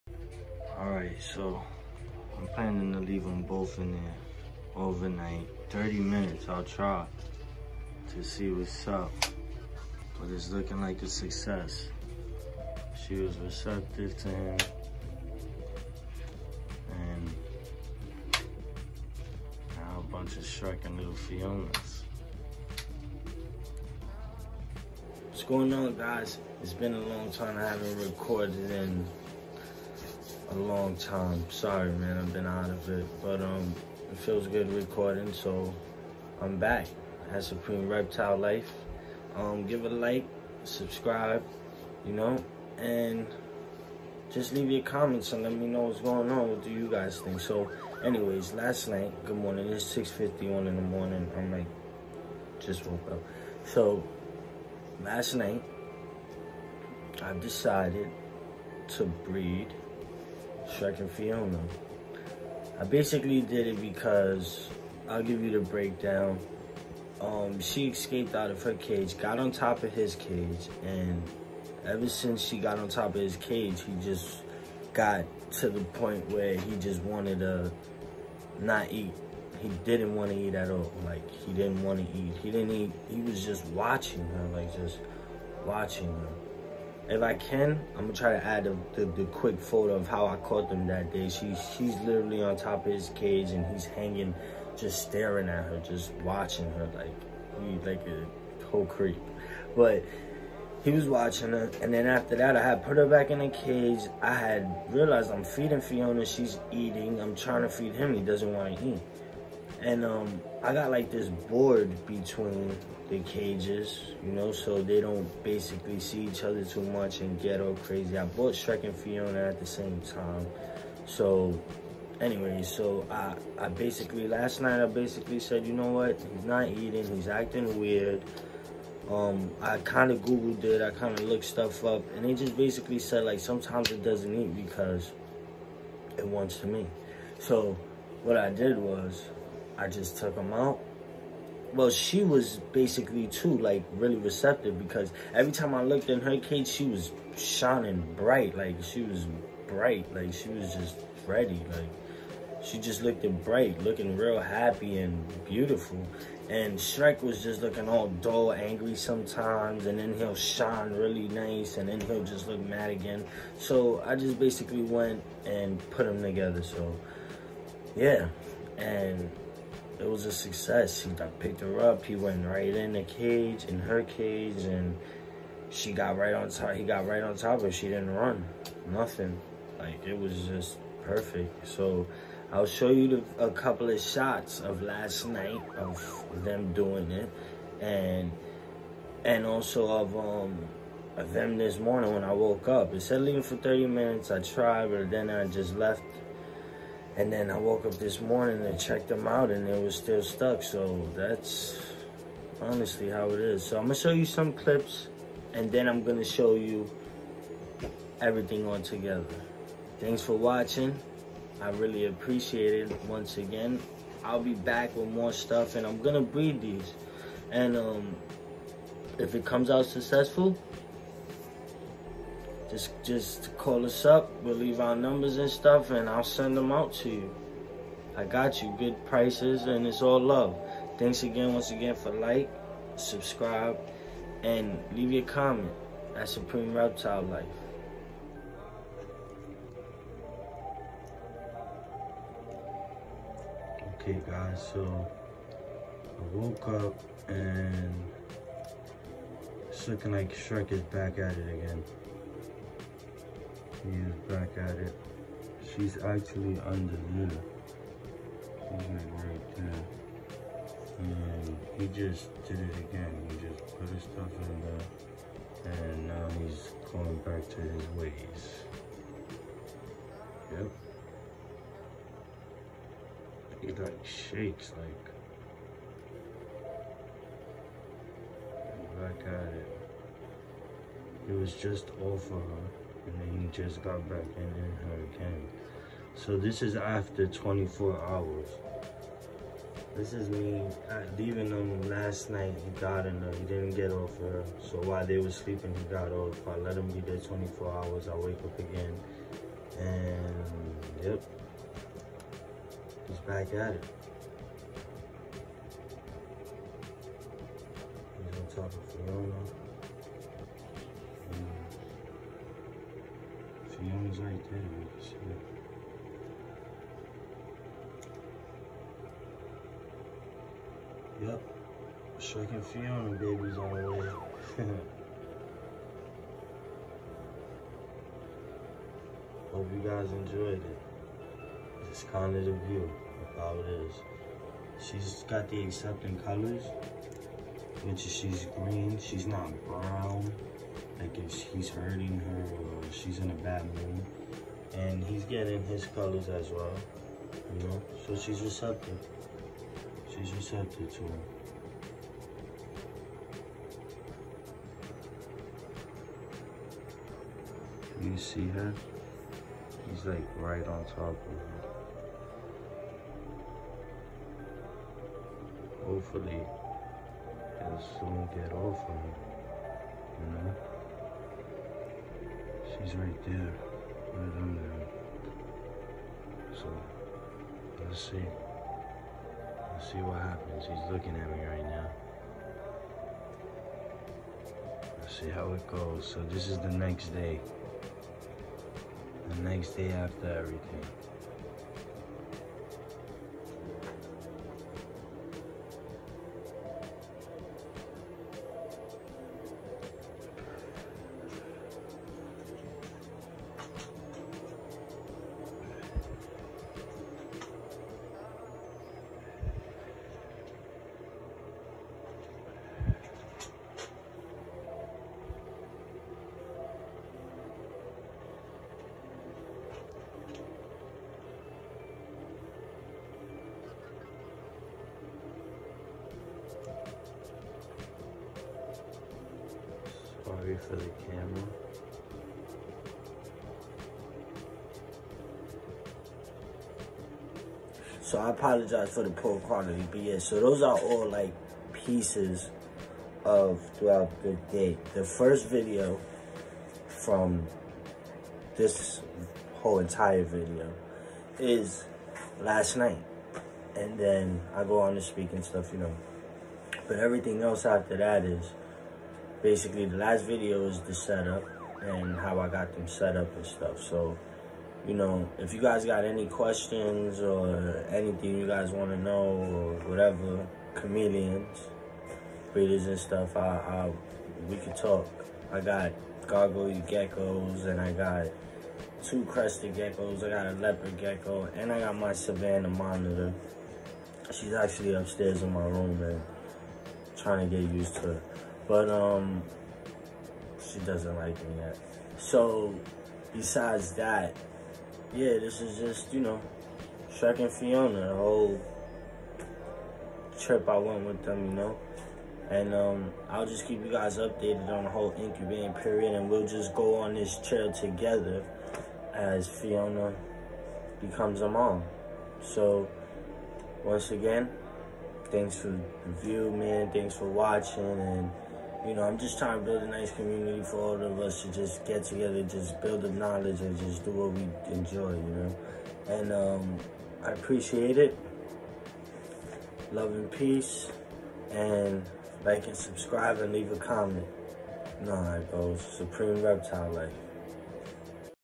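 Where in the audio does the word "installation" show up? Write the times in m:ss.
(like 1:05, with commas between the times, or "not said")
not said.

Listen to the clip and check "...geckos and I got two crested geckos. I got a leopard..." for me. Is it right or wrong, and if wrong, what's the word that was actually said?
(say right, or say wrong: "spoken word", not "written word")
right.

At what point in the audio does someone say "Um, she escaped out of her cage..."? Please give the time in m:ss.
1:07.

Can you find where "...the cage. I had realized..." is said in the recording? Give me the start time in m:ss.
1:43.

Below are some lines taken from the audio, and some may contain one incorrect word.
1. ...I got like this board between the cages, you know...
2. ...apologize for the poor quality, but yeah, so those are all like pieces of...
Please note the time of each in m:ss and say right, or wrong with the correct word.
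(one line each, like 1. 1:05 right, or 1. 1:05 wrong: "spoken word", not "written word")
1. 1:50 right
2. 7:18 right.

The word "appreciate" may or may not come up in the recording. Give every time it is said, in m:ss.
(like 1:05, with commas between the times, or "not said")
3:32, 8:47.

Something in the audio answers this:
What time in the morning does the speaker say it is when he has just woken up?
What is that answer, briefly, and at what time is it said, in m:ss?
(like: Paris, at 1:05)
6:51, at 0:49.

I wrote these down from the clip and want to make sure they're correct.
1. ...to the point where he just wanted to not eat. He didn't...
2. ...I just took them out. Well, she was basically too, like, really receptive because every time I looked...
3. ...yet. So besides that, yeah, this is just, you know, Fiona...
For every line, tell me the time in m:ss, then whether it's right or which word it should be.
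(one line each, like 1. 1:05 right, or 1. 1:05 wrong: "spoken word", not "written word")
1. 1:15 right
2. 2:19 right
3. 8:11 wrong: "Shrek", not "Fiona".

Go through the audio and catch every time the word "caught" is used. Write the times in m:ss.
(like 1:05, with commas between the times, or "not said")
1:30.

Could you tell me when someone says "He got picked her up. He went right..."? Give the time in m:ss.
2:51.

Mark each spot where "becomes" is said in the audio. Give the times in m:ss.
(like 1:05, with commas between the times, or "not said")
8:30.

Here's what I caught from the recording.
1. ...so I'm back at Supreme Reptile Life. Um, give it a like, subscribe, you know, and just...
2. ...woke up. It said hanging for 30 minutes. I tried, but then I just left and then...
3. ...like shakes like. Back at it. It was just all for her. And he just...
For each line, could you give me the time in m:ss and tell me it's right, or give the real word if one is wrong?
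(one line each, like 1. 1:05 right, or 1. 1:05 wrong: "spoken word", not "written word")
1. 0:35 right
2. 3:12 wrong: "leaving", not "hanging"
3. 4:33 right.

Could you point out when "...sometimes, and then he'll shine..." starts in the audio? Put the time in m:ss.
2:38.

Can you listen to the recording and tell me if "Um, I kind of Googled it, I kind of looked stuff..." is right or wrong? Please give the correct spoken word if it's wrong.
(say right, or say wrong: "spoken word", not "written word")
right.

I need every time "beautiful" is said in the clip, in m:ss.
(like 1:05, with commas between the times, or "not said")
2:35.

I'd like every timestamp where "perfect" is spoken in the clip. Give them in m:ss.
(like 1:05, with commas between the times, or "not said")
3:01.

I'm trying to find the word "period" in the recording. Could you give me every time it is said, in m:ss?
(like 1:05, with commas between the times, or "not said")
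8:25.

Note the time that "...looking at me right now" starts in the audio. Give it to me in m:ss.
6:20.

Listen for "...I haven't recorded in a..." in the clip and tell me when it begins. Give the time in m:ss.
0:27.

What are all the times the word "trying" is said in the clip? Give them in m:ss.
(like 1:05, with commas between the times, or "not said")
1:47, 8:07, 8:39.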